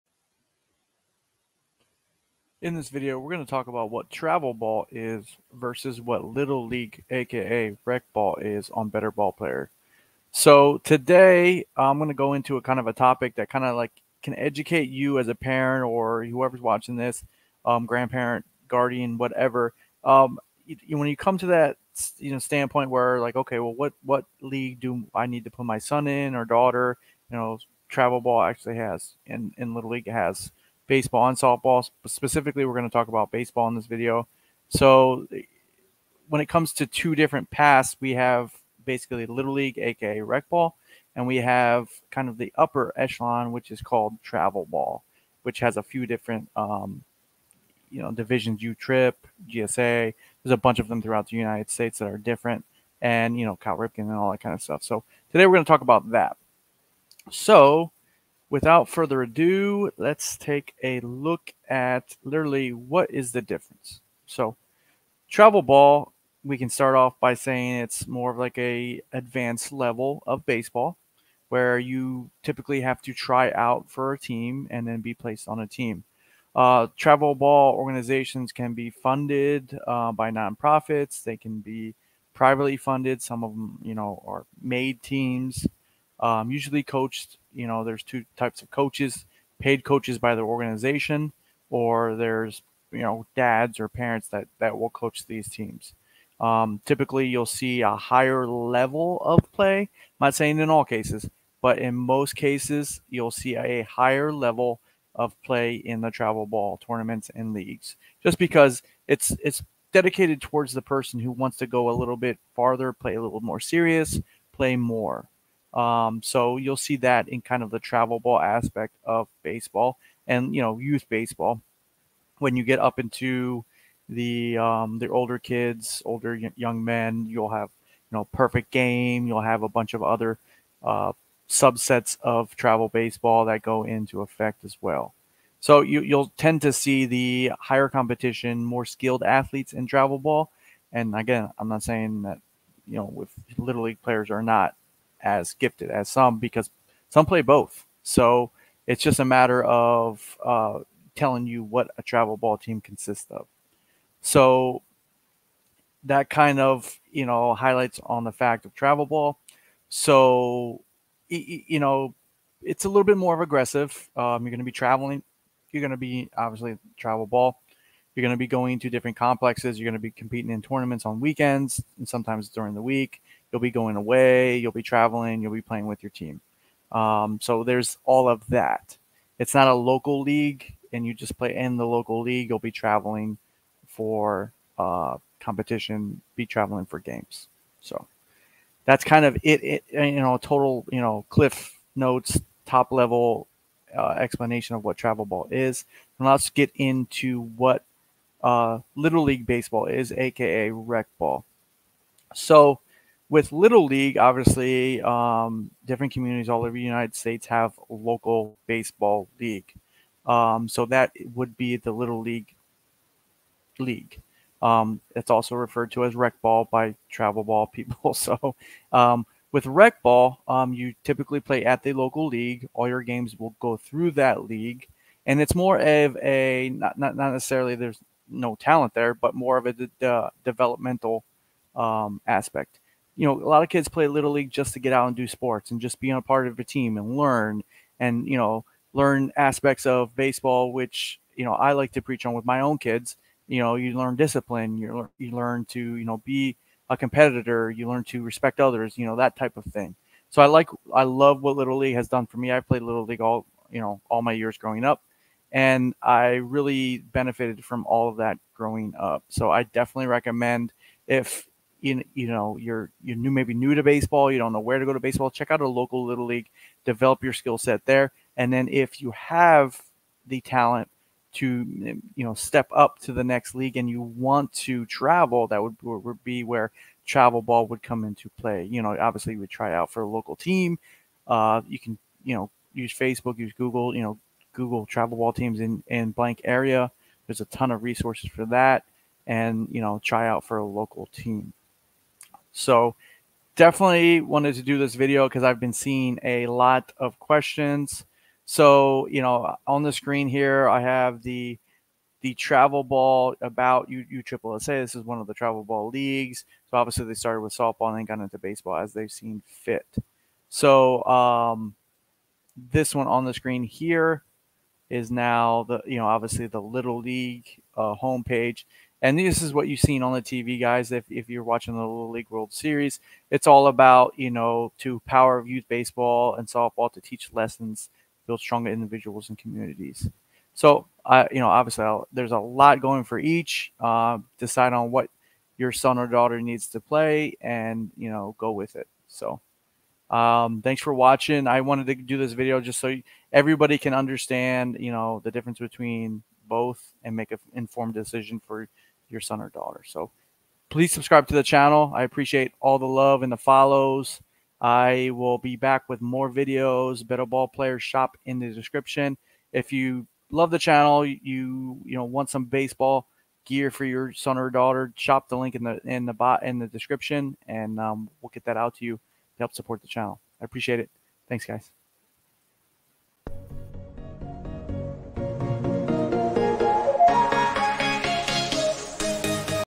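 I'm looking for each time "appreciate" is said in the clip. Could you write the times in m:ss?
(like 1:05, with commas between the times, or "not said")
5:52, 6:10.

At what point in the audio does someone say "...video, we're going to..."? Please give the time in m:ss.
0:02.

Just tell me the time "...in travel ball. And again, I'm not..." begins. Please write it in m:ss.
2:19.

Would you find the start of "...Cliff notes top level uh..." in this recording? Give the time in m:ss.
3:11.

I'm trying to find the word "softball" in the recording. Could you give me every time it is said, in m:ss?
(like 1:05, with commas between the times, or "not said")
0:31, 5:07, 5:26.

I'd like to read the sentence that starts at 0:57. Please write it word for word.
So without further ado, let's take a look at literally what is the difference.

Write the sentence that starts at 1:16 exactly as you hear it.
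Uh, travel ball organizations can be funded uh, by nonprofits.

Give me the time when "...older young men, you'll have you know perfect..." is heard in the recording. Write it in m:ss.
2:06.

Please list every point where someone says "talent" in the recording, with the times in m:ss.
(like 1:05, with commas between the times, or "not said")
3:48, 4:30.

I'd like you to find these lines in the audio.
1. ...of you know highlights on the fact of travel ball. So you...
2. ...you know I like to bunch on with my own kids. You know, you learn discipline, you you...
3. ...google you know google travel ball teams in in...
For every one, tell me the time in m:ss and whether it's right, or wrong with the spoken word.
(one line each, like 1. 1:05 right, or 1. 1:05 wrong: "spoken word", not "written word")
1. 2:36 right
2. 4:01 wrong: "preach", not "bunch"
3. 4:43 right.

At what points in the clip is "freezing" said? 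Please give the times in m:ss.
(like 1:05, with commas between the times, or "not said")
not said.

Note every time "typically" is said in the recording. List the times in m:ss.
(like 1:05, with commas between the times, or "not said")
1:12, 1:36, 3:41.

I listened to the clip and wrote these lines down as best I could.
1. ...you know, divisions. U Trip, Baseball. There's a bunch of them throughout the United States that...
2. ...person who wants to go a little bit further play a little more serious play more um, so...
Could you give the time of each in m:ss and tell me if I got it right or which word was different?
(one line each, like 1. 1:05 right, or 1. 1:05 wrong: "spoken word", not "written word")
1. 0:47 wrong: "GSA", not "Baseball"
2. 1:50 wrong: "farther", not "further".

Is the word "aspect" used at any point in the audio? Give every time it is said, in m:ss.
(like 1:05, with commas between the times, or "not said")
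1:58, 3:52, 3:59.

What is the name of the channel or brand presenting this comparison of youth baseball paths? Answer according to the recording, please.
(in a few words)
Better BallPlayer.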